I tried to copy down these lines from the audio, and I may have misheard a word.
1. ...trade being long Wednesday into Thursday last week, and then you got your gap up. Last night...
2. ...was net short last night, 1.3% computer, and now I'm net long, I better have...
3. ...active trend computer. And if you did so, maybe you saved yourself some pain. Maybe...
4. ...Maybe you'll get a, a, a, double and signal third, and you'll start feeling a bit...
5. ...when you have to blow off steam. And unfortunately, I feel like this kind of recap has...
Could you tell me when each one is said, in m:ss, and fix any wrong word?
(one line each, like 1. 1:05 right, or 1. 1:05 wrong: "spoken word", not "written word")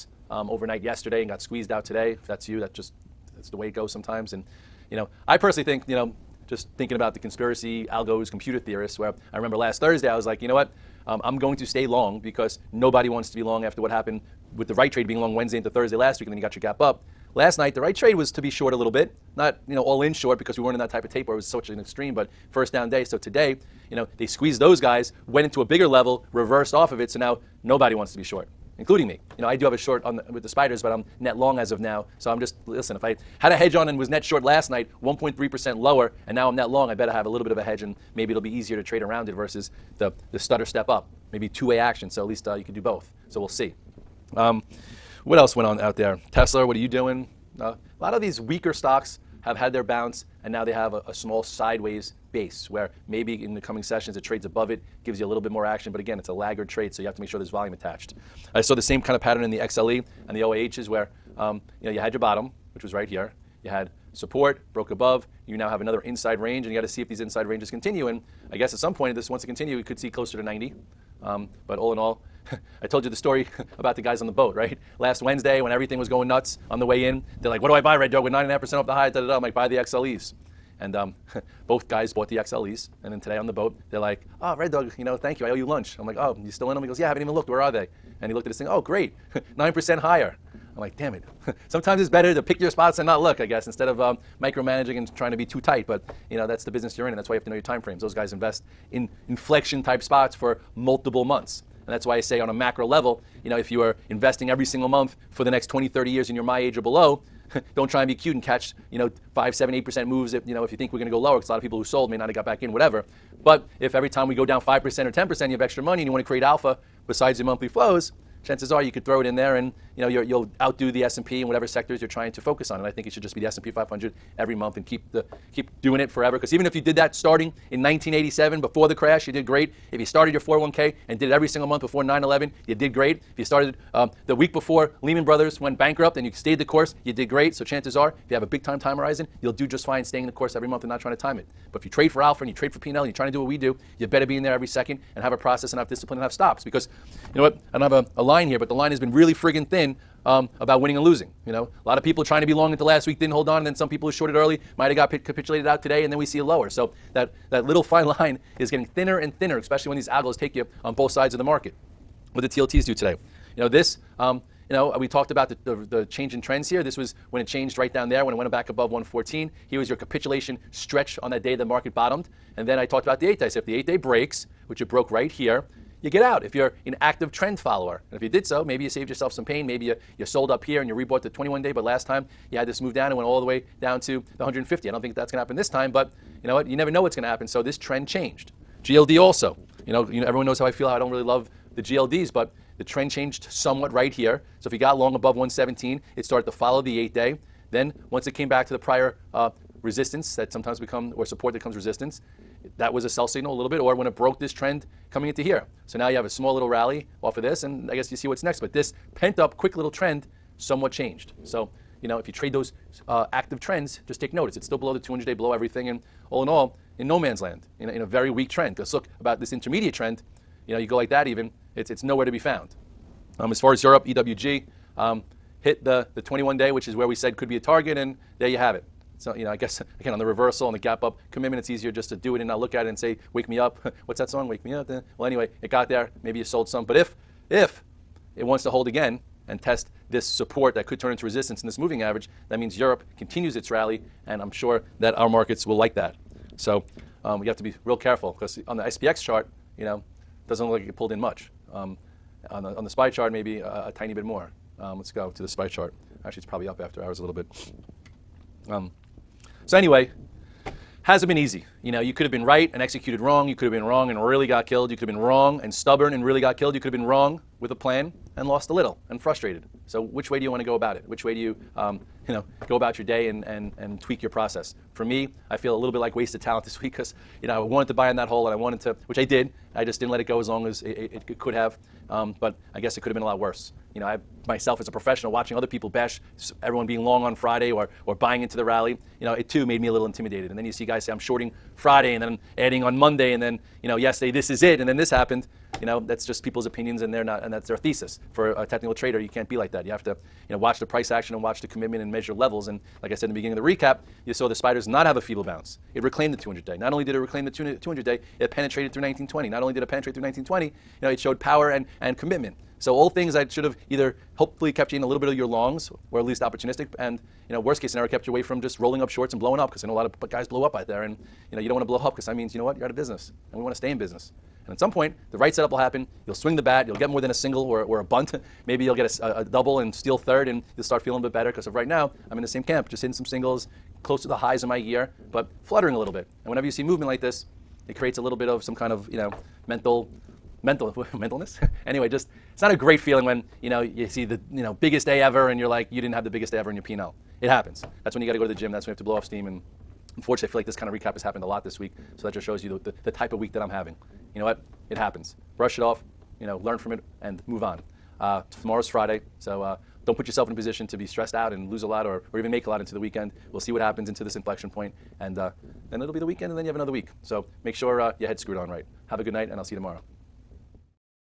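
1. 0:14 right
2. 0:33 wrong: "lower", not "computer"
3. 2:57 wrong: "follower", not "computer"
4. 5:28 wrong: "steal", not "signal"
5. 5:48 right.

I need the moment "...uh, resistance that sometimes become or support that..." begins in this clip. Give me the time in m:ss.
3:19.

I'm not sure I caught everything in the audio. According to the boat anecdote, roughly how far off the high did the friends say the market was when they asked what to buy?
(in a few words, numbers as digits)
nine and a half percent.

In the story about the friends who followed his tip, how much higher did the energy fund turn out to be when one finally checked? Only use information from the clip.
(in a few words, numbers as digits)
9%.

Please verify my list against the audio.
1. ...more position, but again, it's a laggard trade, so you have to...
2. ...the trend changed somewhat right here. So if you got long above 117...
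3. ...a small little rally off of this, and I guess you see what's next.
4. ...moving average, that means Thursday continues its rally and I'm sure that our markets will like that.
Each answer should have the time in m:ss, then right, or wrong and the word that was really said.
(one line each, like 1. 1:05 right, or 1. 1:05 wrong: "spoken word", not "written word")
1. 0:55 wrong: "action", not "position"
2. 3:12 right
3. 3:26 right
4. 4:01 wrong: "Europe", not "Thursday".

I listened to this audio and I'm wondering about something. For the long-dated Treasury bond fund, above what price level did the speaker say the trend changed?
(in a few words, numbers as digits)
114.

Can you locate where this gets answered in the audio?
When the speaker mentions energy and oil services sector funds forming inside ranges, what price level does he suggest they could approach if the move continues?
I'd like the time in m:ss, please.
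1:10.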